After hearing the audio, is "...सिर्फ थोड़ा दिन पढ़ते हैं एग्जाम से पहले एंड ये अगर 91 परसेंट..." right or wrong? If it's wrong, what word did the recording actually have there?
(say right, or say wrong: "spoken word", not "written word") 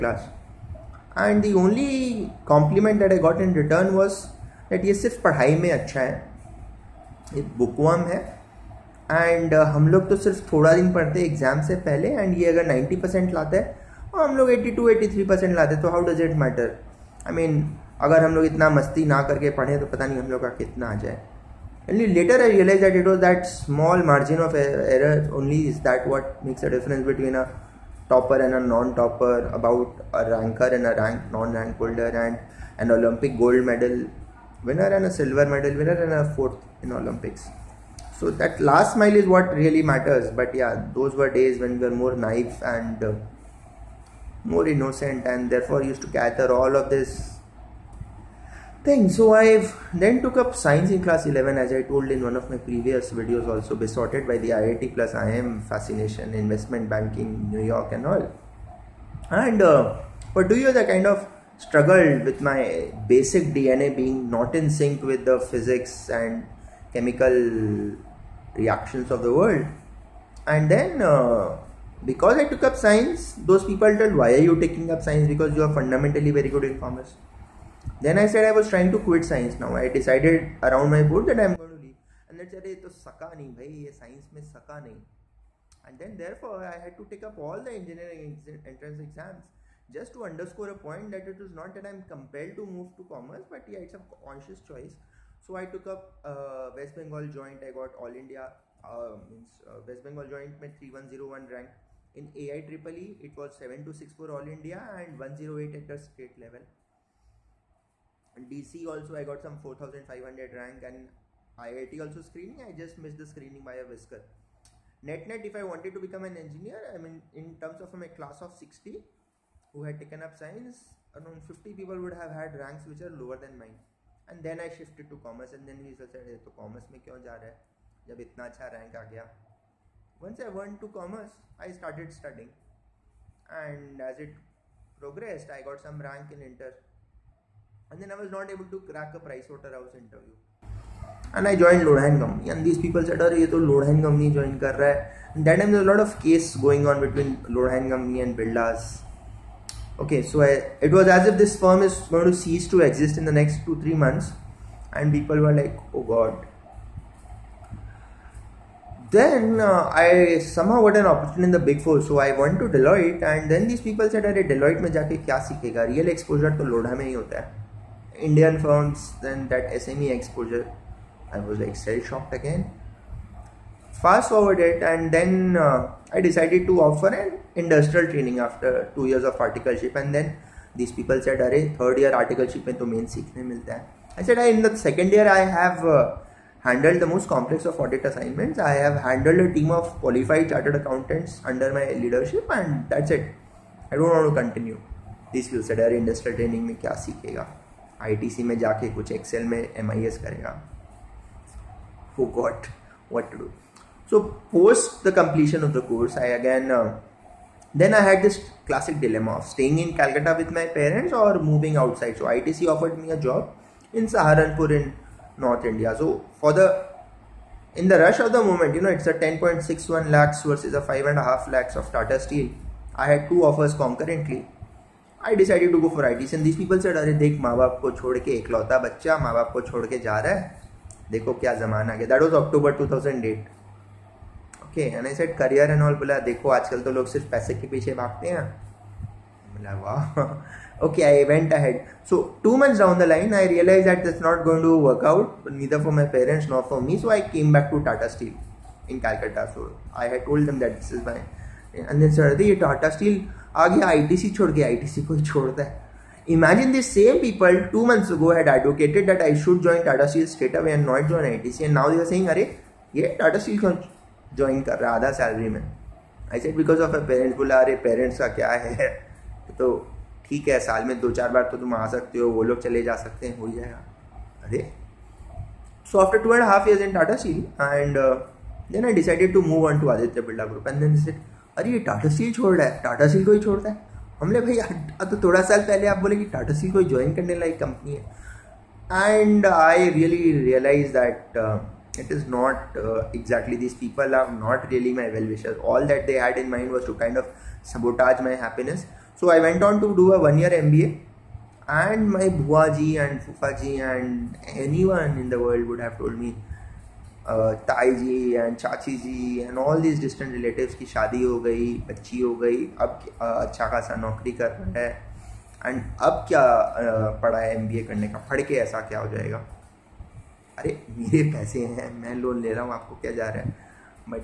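wrong: "90", not "91".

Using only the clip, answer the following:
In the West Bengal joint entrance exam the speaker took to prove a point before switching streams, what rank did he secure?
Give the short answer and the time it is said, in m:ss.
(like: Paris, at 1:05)
3101, at 1:40.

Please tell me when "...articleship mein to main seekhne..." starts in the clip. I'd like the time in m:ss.
3:02.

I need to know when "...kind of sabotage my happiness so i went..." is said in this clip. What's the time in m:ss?
4:56.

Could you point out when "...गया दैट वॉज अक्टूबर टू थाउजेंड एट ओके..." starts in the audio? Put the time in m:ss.
3:51.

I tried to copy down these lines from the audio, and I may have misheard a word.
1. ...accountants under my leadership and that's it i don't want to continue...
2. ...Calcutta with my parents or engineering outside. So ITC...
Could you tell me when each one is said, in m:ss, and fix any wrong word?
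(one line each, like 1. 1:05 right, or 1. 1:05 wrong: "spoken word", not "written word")
1. 3:10 right
2. 3:29 wrong: "moving", not "engineering".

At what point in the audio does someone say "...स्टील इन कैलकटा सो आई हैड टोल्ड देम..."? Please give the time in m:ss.
4:08.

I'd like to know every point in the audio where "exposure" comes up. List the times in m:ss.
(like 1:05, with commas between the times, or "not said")
2:46, 2:50.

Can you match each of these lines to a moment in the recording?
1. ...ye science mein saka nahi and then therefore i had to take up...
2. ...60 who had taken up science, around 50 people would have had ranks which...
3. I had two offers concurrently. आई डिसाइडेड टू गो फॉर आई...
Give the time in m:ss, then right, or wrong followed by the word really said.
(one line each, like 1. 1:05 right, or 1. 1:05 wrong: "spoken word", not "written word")
1. 1:23 right
2. 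1:58 right
3. 3:42 right.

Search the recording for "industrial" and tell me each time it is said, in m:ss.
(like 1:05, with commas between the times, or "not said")
2:57, 3:16.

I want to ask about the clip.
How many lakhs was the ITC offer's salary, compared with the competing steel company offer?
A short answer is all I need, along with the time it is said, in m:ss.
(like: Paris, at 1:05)
10.61 lakhs, at 3:39.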